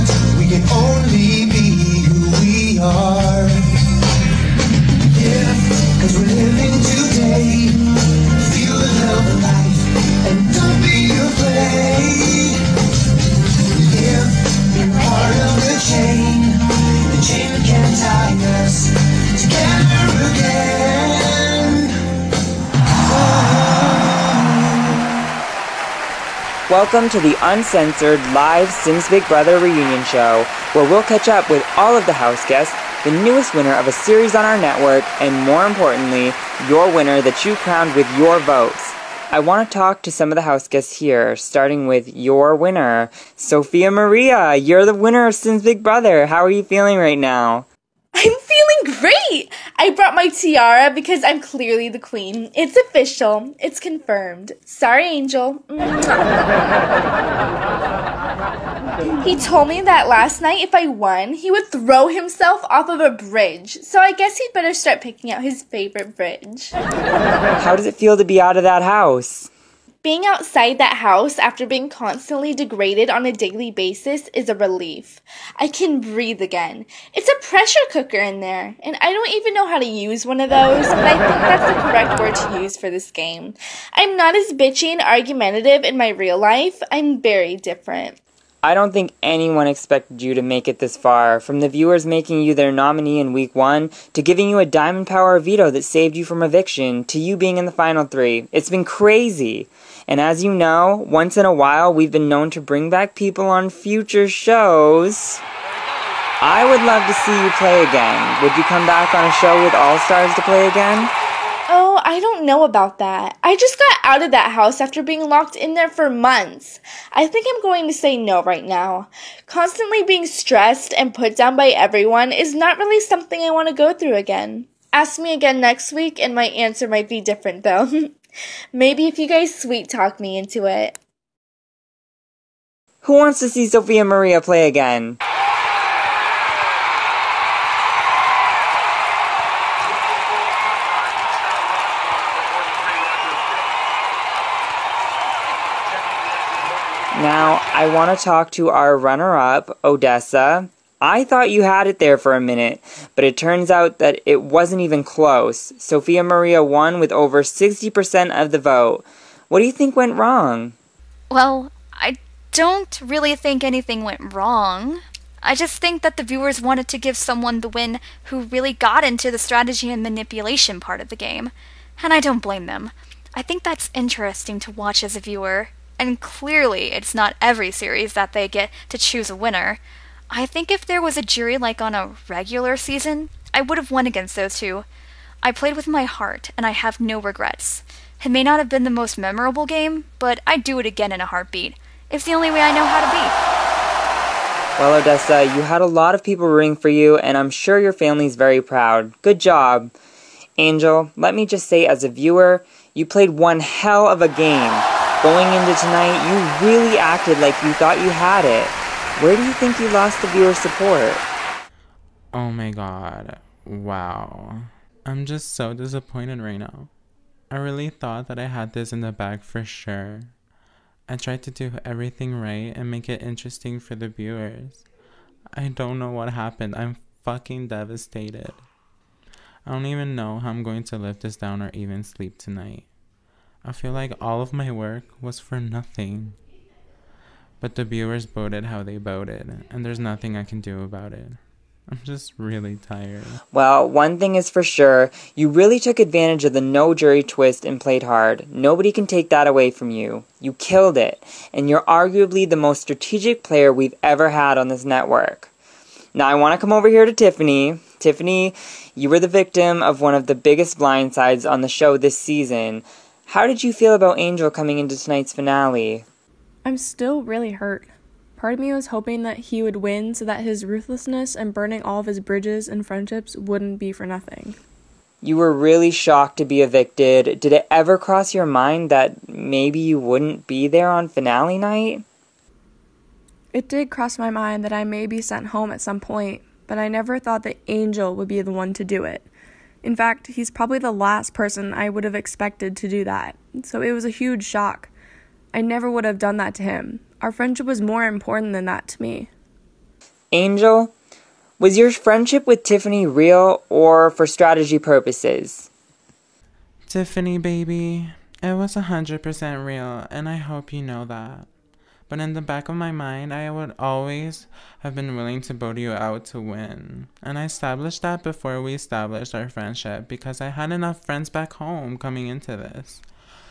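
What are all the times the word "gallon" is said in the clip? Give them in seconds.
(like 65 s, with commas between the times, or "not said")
not said.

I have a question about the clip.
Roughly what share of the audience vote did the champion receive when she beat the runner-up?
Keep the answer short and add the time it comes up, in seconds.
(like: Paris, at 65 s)
over 60%, at 157 s.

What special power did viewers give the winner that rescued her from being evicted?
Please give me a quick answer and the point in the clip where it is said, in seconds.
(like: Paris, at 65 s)
diamond power veto, at 94 s.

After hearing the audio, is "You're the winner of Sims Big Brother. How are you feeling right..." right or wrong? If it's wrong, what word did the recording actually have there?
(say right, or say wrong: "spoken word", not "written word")
right.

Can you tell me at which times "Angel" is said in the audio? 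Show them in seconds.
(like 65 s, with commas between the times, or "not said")
55 s, 200 s, 264 s, 287 s, 300 s.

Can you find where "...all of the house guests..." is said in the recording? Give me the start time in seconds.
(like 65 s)
31 s.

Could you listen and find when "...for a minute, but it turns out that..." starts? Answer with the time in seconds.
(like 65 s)
152 s.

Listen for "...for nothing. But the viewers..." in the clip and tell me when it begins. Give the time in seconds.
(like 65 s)
235 s.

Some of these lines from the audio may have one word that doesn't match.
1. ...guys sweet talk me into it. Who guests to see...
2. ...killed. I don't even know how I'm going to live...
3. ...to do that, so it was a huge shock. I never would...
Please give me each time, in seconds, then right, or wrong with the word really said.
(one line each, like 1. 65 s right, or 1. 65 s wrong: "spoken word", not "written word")
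1. 129 s wrong: "wants", not "guests"
2. 227 s wrong: "devastated", not "killed"
3. 292 s right.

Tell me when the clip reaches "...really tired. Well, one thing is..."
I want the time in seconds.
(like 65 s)
242 s.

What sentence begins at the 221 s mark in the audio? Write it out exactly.
I tried to do everything right and make it interesting for the viewers.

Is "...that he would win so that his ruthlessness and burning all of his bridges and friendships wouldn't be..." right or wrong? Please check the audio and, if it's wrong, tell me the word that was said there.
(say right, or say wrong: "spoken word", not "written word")
right.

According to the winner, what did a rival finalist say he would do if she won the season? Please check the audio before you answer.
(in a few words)
throw himself off of a bridge.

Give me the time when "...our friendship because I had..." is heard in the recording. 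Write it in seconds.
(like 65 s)
319 s.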